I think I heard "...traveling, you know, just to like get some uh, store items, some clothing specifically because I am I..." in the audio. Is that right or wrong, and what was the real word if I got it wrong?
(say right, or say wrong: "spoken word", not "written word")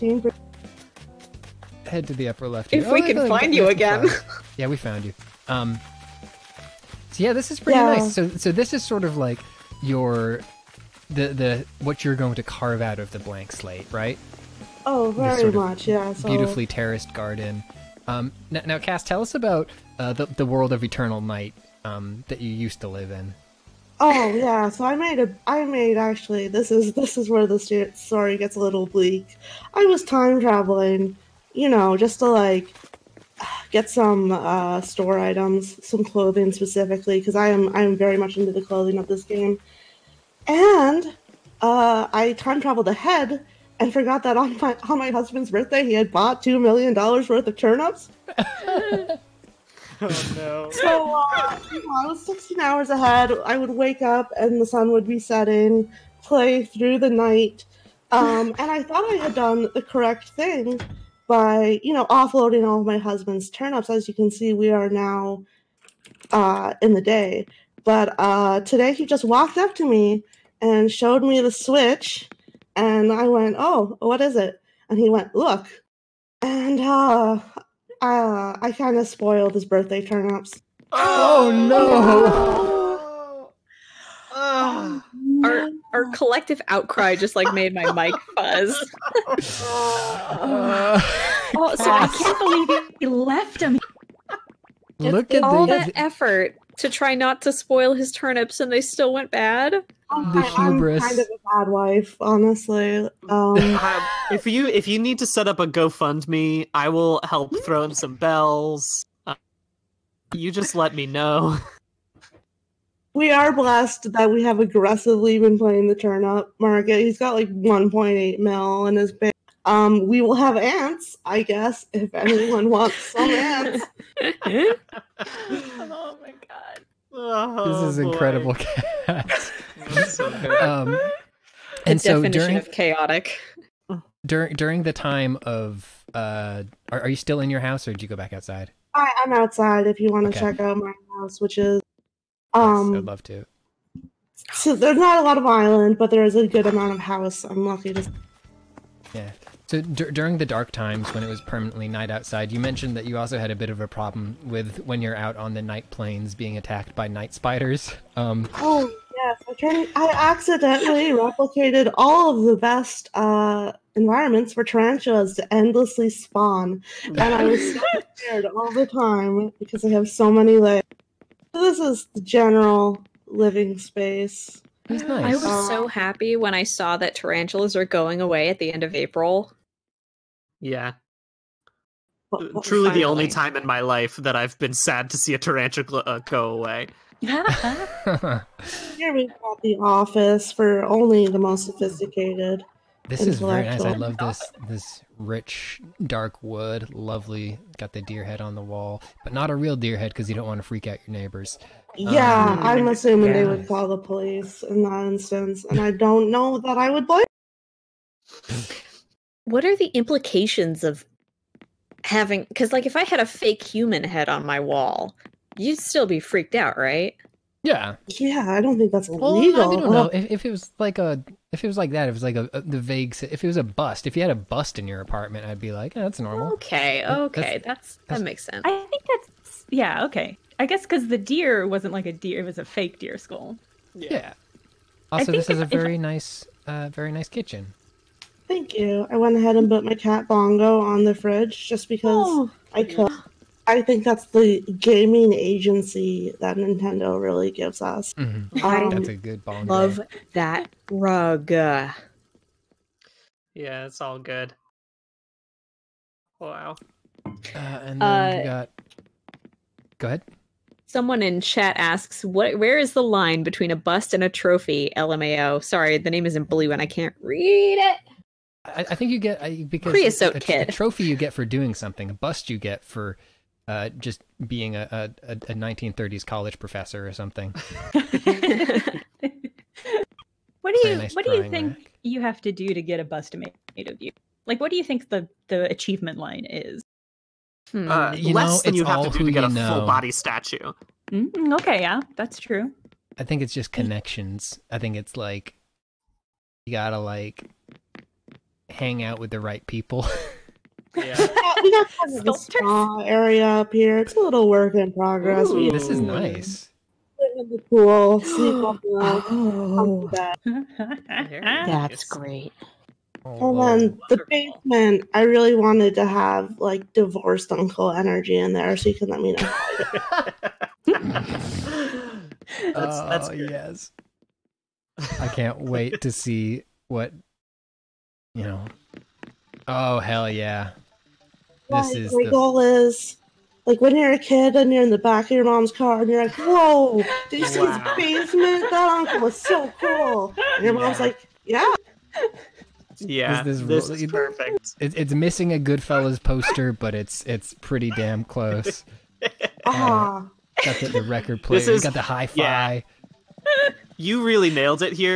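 right.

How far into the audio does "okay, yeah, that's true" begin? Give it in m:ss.
4:51.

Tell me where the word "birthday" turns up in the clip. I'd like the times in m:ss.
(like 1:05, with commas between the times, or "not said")
0:45, 1:19.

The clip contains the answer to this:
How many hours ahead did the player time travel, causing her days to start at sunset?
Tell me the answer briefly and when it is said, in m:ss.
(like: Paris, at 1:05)
16, at 0:52.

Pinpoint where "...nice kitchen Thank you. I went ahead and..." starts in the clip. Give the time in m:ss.
3:57.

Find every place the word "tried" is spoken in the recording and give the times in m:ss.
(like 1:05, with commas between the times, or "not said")
2:39.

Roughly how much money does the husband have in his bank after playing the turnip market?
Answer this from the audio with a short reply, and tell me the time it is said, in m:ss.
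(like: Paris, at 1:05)
1.8 mil, at 1:57.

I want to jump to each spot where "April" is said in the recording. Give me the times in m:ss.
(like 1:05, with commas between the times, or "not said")
2:58.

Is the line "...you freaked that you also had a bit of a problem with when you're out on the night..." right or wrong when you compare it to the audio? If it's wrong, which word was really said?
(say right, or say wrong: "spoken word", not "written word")
wrong: "mentioned", not "freaked".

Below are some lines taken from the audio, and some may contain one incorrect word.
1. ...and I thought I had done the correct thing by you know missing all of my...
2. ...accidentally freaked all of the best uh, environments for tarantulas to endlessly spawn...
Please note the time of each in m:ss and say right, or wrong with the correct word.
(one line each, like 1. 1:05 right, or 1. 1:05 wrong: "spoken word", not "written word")
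1. 0:58 wrong: "offloading", not "missing"
2. 2:40 wrong: "replicated", not "freaked".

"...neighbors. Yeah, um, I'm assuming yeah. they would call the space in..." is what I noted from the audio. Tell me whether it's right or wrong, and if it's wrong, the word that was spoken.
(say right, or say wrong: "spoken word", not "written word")
wrong: "police", not "space".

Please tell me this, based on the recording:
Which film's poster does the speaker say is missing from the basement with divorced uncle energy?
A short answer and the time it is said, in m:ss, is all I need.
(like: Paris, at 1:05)
Goodfellas, at 5:45.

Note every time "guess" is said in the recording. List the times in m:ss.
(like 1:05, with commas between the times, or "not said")
2:01, 3:50.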